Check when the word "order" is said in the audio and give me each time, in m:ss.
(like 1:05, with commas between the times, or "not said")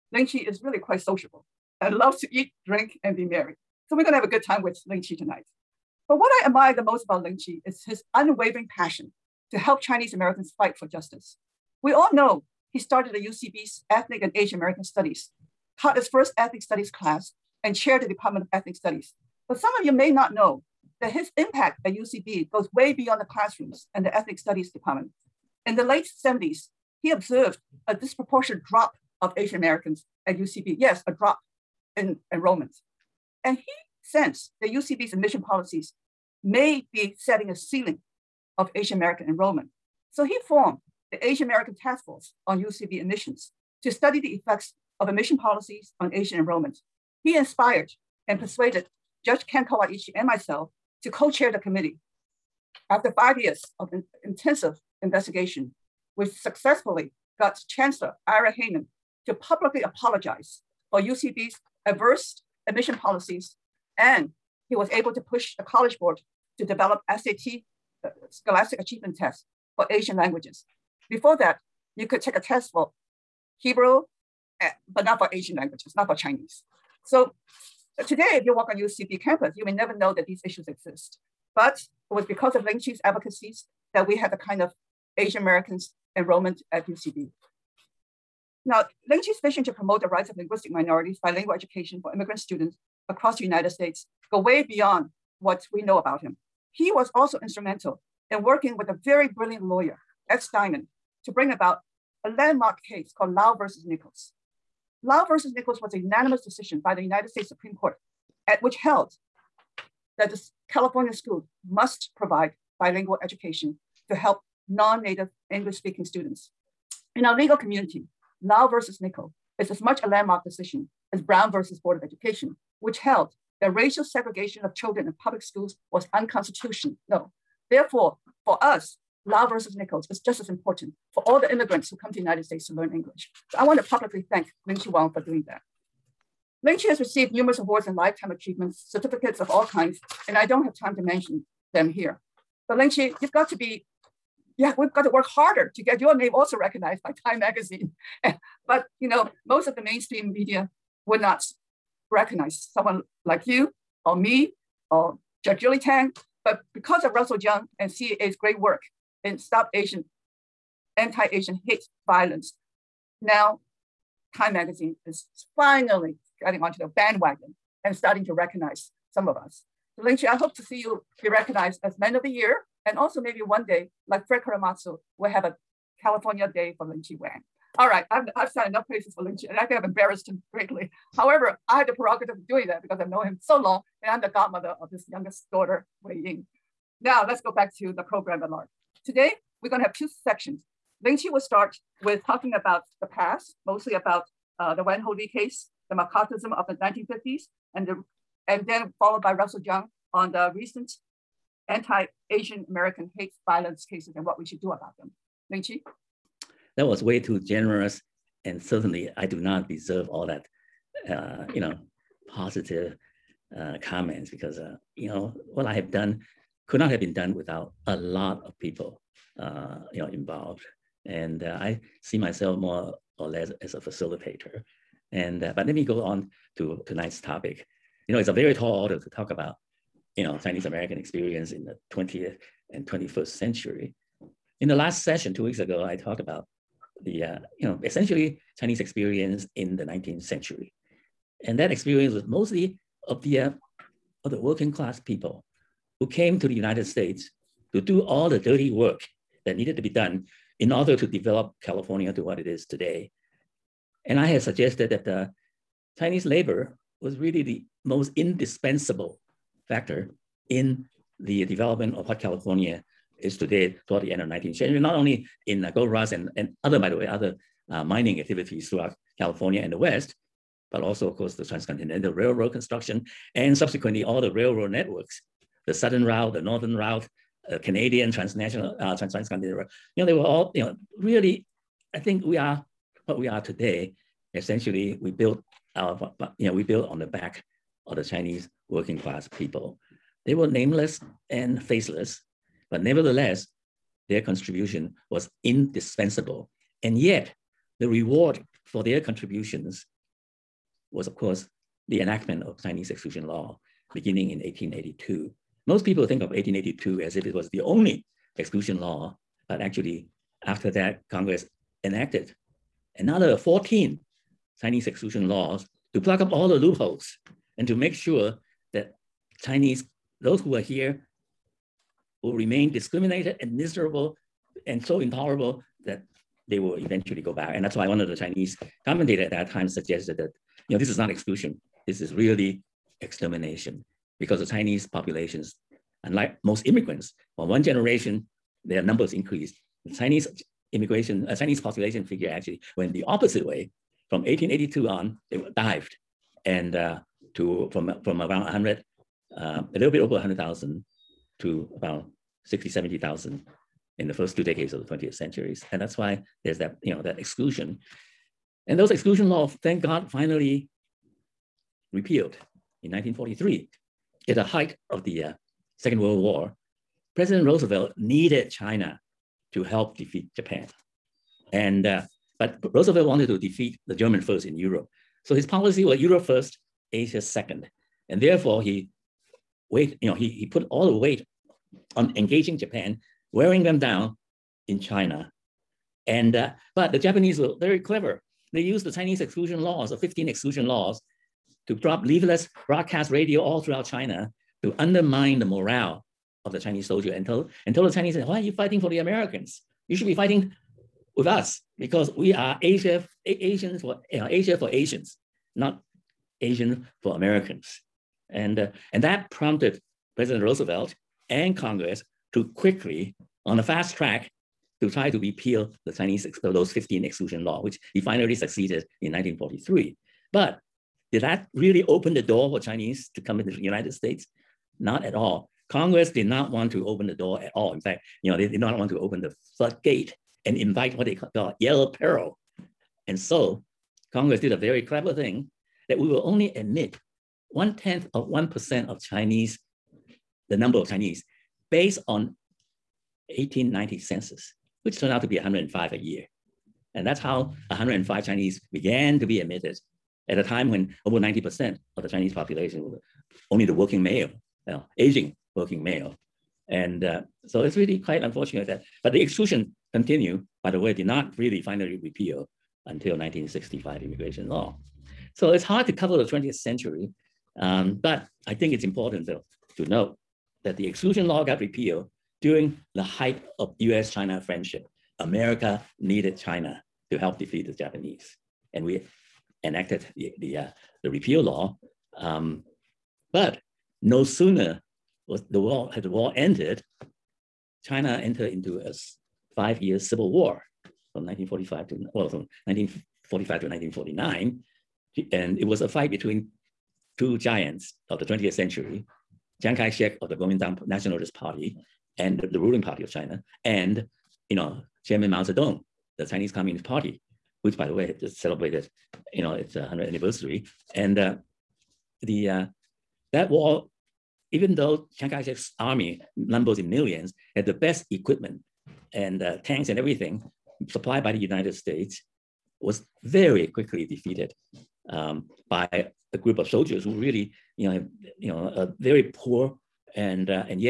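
3:48, 4:10.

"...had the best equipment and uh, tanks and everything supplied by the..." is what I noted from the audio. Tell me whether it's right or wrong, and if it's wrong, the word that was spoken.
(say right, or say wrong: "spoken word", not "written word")
right.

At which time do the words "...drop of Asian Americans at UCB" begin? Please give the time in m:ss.
0:28.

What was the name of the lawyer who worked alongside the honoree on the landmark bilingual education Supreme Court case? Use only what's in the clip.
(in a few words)
S. Steinman.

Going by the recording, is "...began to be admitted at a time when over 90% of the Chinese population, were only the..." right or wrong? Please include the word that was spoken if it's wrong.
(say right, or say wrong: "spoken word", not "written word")
right.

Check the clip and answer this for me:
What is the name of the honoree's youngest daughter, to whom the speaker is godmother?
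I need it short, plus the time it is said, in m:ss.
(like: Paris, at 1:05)
Wei Ying, at 3:06.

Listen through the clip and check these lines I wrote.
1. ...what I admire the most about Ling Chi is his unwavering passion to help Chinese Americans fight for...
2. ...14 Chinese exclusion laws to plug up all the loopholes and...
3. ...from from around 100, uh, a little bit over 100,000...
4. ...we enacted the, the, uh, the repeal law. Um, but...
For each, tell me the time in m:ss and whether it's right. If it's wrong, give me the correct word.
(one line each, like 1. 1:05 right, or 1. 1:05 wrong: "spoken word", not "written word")
1. 0:06 right
2. 5:13 right
3. 5:47 right
4. 7:58 right.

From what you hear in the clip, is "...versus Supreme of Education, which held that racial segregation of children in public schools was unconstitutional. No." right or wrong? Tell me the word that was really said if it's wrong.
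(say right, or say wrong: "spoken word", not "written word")
wrong: "Board", not "Supreme".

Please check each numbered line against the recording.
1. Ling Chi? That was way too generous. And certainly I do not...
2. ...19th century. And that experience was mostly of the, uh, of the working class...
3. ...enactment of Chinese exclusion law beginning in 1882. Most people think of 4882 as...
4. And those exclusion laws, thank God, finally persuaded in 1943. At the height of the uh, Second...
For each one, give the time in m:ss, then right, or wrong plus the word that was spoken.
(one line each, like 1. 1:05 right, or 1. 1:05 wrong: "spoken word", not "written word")
1. 3:25 right
2. 3:59 right
3. 5:02 wrong: "1882", not "4882"
4. 5:58 wrong: "repealed", not "persuaded".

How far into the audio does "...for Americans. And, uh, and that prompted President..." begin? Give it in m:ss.
6:47.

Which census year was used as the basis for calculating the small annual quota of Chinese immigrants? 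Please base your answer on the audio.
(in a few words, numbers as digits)
1890.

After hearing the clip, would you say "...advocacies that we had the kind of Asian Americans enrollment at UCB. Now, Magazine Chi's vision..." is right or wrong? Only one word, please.
wrong.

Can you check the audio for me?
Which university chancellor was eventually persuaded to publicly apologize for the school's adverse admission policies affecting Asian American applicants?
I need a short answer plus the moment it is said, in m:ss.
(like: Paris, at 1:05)
Ira Heyman, at 0:58.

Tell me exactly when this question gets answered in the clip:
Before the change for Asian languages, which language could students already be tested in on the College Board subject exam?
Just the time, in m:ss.
1:13.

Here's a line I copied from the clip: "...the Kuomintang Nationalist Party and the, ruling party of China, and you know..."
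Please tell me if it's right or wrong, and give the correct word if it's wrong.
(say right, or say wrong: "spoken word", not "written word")
right.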